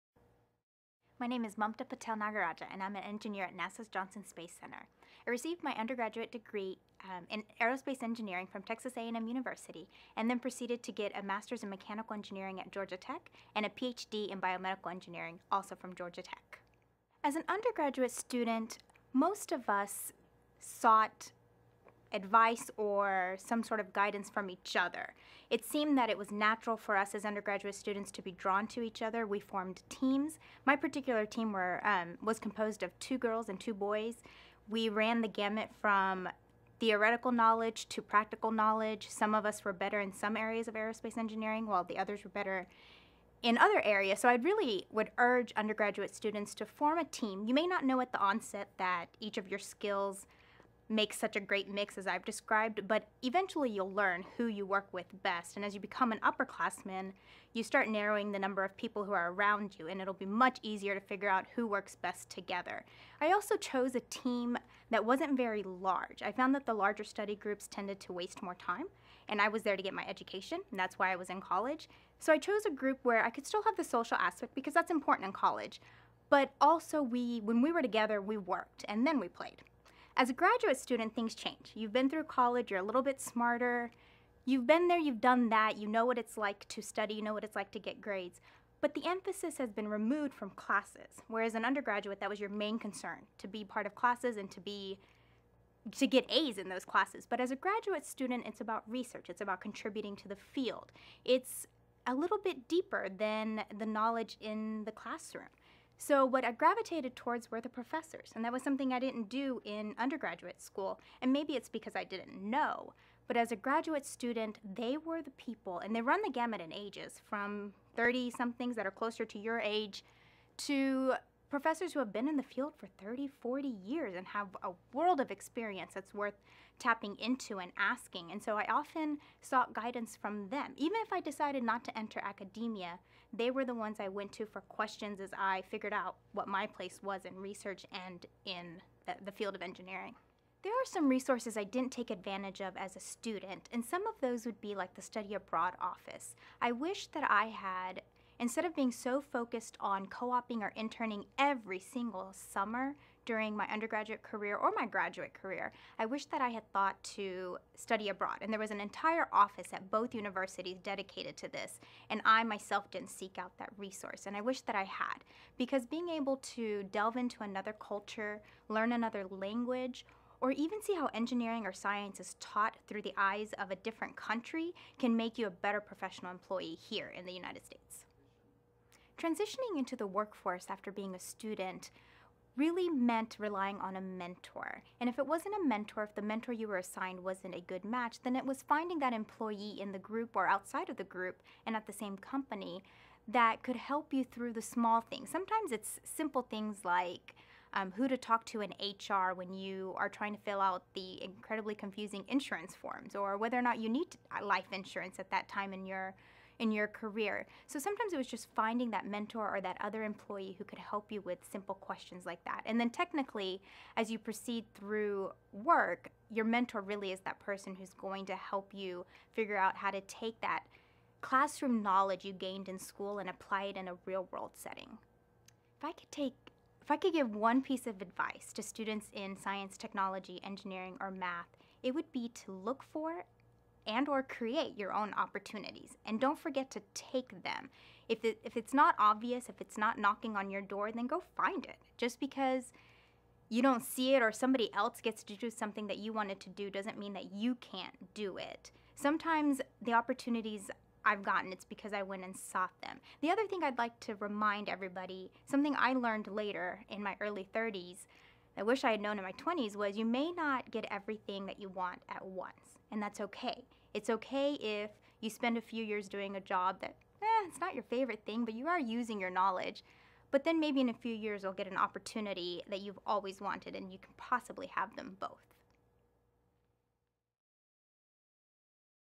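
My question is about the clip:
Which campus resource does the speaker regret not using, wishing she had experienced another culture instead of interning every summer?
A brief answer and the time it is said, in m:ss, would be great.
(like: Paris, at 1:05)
Study Abroad office, at 2:25.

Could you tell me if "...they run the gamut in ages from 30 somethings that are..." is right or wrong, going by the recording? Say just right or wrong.
right.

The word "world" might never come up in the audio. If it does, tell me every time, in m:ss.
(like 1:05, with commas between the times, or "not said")
2:04, 3:44.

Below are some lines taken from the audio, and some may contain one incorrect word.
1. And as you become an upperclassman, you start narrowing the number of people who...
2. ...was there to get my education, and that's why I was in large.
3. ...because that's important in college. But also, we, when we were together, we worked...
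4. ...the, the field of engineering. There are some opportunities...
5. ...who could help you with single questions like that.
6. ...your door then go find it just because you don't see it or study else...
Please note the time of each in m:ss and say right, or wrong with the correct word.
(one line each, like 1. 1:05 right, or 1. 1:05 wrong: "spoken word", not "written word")
1. 0:55 right
2. 1:09 wrong: "college", not "large"
3. 1:14 right
4. 2:19 wrong: "resources", not "opportunities"
5. 3:30 wrong: "simple", not "single"
6. 4:00 wrong: "somebody", not "study".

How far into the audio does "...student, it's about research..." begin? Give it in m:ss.
1:38.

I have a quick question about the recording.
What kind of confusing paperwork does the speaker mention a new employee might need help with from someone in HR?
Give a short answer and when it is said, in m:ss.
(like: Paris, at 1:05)
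insurance forms, at 3:22.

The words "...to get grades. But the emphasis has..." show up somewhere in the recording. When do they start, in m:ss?
1:27.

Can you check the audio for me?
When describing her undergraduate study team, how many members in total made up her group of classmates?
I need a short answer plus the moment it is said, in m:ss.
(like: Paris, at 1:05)
4, at 0:32.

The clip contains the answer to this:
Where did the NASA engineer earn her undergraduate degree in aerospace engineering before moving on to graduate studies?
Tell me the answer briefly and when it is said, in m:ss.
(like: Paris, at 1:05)
Texas A&M University, at 0:08.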